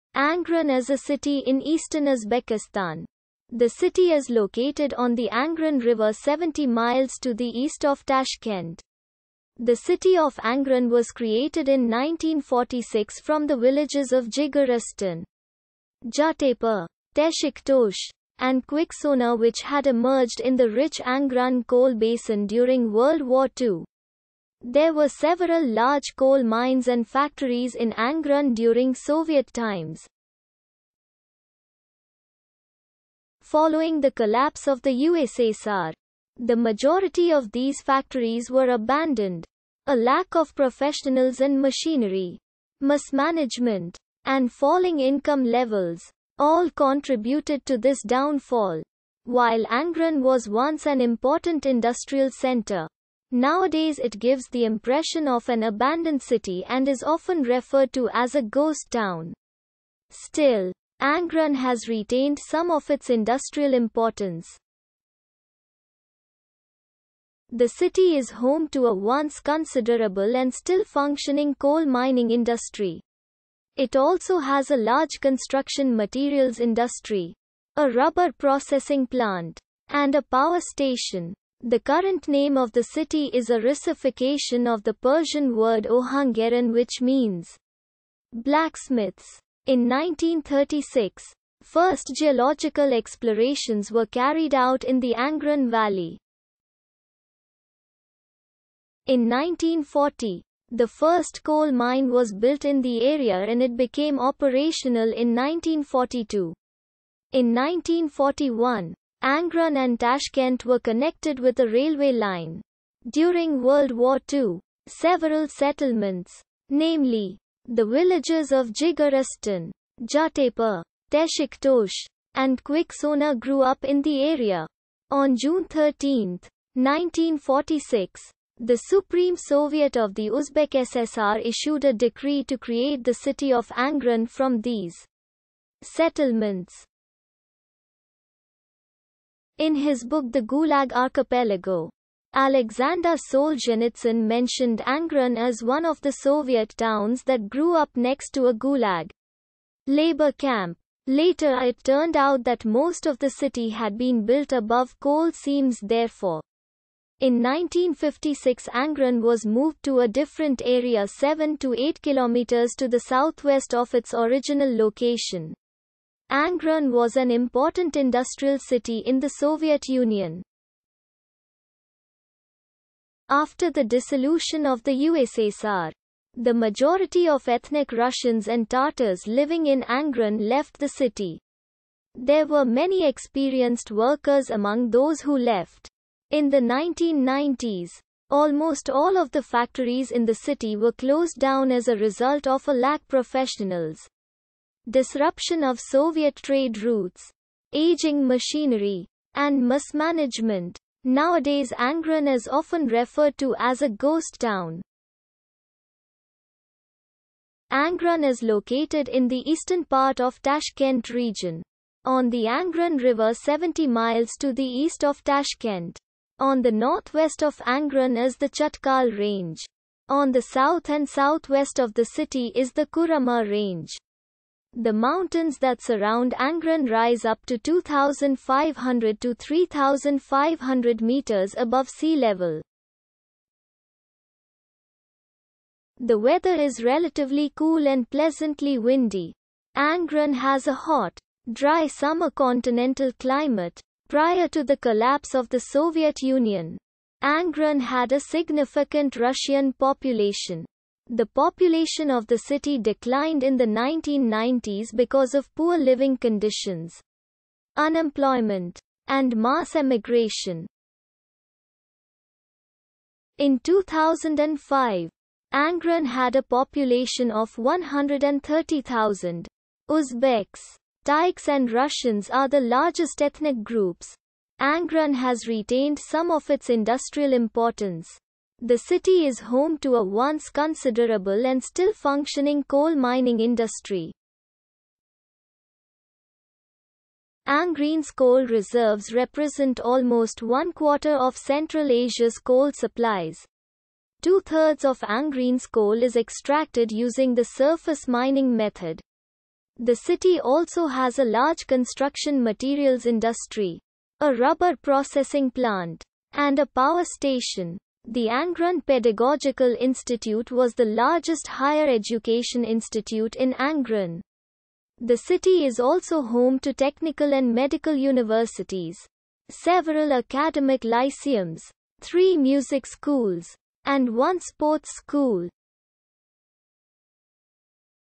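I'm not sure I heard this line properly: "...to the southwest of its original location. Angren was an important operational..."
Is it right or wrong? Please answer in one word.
wrong.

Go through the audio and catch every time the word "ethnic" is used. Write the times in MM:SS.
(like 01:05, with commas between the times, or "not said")
02:57, 04:33.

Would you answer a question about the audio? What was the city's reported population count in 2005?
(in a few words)
130,000.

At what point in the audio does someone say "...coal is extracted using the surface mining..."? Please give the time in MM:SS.
04:55.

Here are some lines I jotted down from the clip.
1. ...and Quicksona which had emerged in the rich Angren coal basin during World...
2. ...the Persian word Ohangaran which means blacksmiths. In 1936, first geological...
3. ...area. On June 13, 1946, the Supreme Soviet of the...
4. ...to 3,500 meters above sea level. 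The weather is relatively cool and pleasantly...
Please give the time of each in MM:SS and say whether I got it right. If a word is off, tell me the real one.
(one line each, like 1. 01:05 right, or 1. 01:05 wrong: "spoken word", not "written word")
1. 00:18 right
2. 01:24 right
3. 02:04 right
4. 03:49 right.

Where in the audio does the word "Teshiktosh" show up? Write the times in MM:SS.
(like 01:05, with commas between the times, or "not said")
00:17, 02:01.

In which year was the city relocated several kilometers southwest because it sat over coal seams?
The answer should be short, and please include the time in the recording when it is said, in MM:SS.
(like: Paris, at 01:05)
1956, at 02:37.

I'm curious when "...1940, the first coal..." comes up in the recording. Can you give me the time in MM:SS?
01:39.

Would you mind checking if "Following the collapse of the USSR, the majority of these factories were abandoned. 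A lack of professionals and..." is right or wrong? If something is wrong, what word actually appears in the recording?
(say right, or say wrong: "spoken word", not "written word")
right.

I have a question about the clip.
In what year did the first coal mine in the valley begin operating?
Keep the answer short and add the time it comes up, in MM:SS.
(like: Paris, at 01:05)
1942, at 01:45.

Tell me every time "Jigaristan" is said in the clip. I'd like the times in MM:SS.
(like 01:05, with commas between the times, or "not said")
00:14, 01:58.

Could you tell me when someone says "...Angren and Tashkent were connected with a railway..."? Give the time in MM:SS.
01:49.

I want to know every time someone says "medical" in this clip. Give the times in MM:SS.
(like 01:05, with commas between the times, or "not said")
05:17.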